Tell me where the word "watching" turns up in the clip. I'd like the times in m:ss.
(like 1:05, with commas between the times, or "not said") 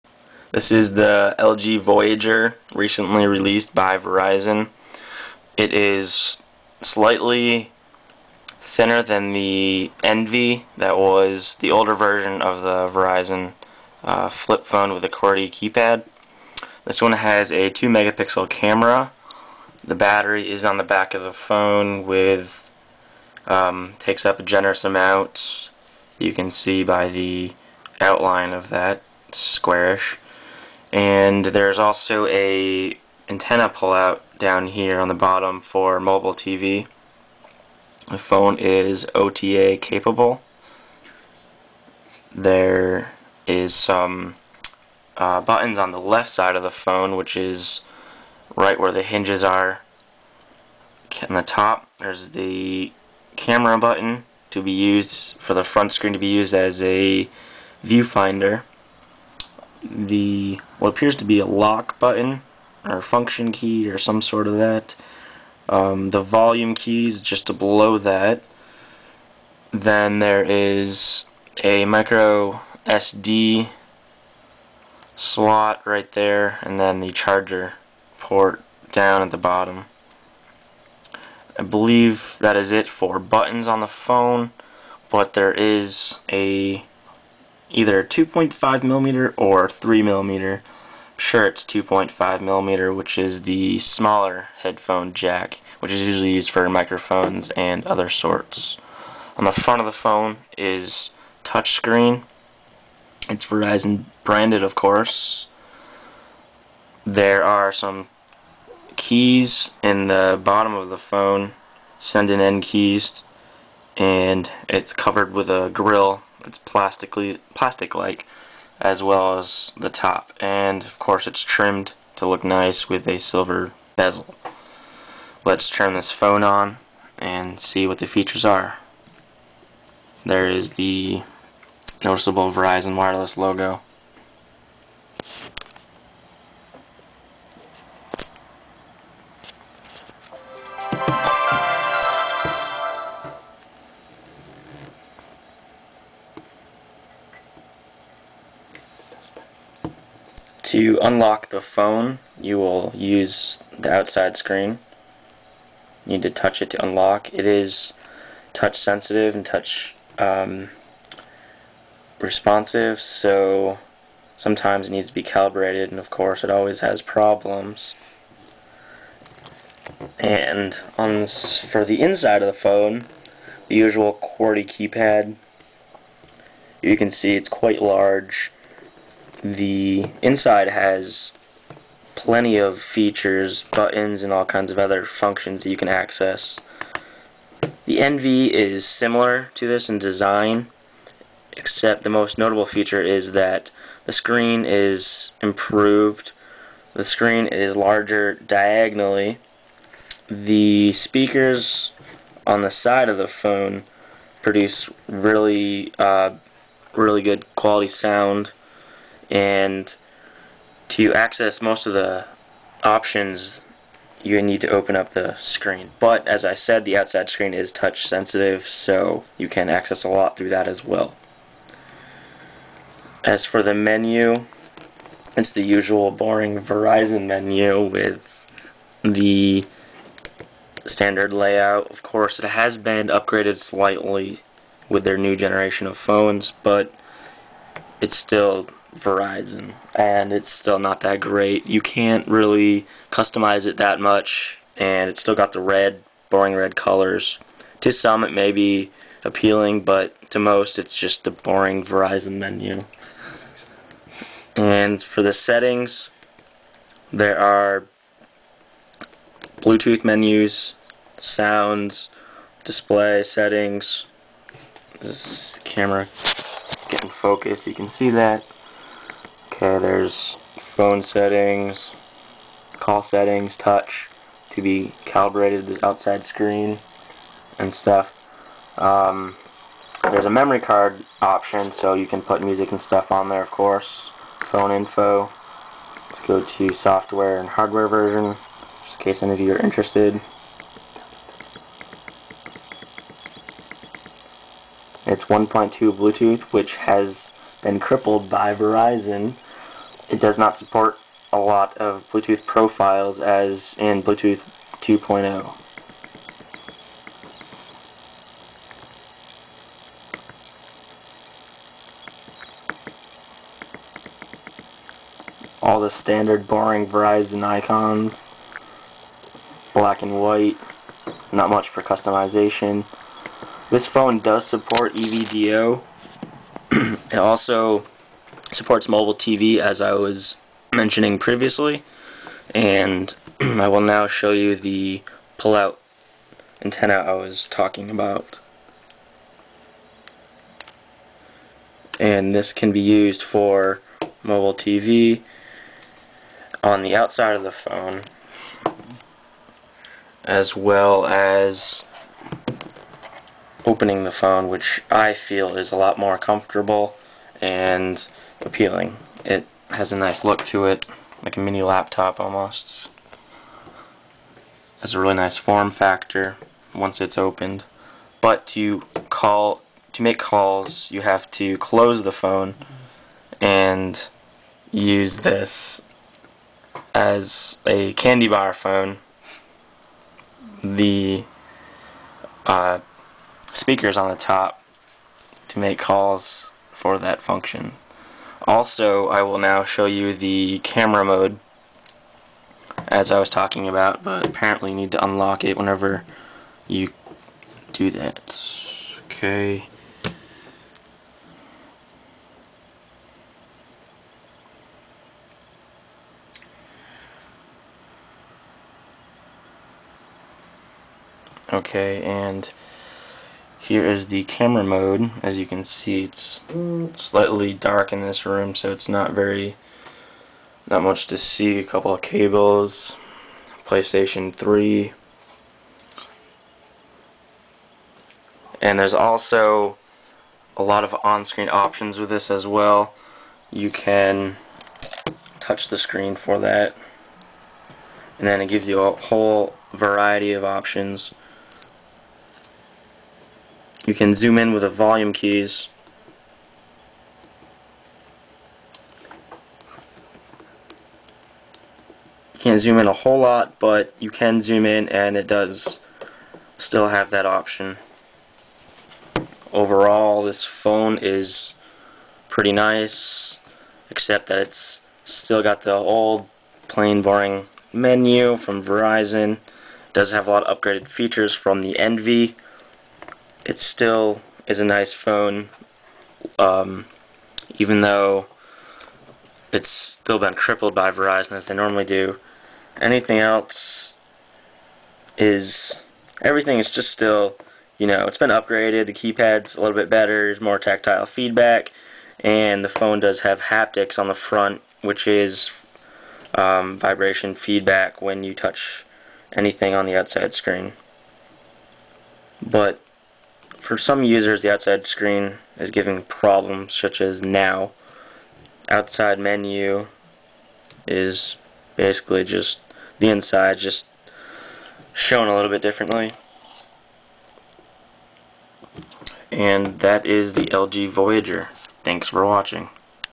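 8:42.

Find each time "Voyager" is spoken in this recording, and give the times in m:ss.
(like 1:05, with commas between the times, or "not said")
0:01, 8:40.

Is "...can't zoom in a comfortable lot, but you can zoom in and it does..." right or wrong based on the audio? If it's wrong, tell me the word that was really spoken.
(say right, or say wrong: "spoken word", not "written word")
wrong: "whole", not "comfortable".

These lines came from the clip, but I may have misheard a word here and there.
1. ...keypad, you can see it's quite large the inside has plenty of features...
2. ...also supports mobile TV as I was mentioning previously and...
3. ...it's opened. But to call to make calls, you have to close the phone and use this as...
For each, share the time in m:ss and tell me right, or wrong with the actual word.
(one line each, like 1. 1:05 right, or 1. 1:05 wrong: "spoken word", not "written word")
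1. 2:54 right
2. 5:27 right
3. 6:07 right.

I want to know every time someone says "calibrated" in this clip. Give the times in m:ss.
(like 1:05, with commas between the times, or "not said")
2:45, 4:35.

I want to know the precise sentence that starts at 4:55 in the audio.
It's 1.2 Bluetooth, which has been crippled by Verizon it does not support a lot of Bluetooth profiles as in Bluetooth 2.0.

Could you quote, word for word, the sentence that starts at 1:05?
Um, the volume keys just below that.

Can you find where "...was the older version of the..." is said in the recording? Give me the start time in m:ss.
0:10.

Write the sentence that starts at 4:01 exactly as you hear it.
You can't really customize it that much, and it's still got the red, boring red colors.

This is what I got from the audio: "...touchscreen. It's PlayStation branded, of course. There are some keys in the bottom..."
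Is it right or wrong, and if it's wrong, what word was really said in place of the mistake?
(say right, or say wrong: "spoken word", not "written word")
wrong: "Verizon", not "PlayStation".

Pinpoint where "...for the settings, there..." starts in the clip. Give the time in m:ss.
4:15.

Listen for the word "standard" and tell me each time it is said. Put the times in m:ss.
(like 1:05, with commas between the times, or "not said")
3:50, 5:15.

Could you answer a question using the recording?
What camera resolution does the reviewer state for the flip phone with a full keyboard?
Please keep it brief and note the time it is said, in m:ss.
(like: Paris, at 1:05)
2 megapixel, at 0:17.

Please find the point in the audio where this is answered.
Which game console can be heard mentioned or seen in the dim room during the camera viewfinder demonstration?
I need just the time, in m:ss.
7:03.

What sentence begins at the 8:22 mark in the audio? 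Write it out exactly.
But for some users, the outside screen is giving problems such as now.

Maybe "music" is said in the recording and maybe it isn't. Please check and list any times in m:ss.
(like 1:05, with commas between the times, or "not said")
4:42.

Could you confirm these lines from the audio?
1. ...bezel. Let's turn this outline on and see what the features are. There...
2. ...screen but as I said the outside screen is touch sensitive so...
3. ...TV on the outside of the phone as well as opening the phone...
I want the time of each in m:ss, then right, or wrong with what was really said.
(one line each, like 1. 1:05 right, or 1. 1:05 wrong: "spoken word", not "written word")
1. 2:03 wrong: "phone", not "outline"
2. 3:35 right
3. 5:44 right.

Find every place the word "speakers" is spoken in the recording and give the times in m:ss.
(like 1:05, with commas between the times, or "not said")
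3:20, 6:23.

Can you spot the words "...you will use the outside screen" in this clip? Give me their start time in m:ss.
2:32.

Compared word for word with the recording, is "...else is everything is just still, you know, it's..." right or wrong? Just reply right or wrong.
right.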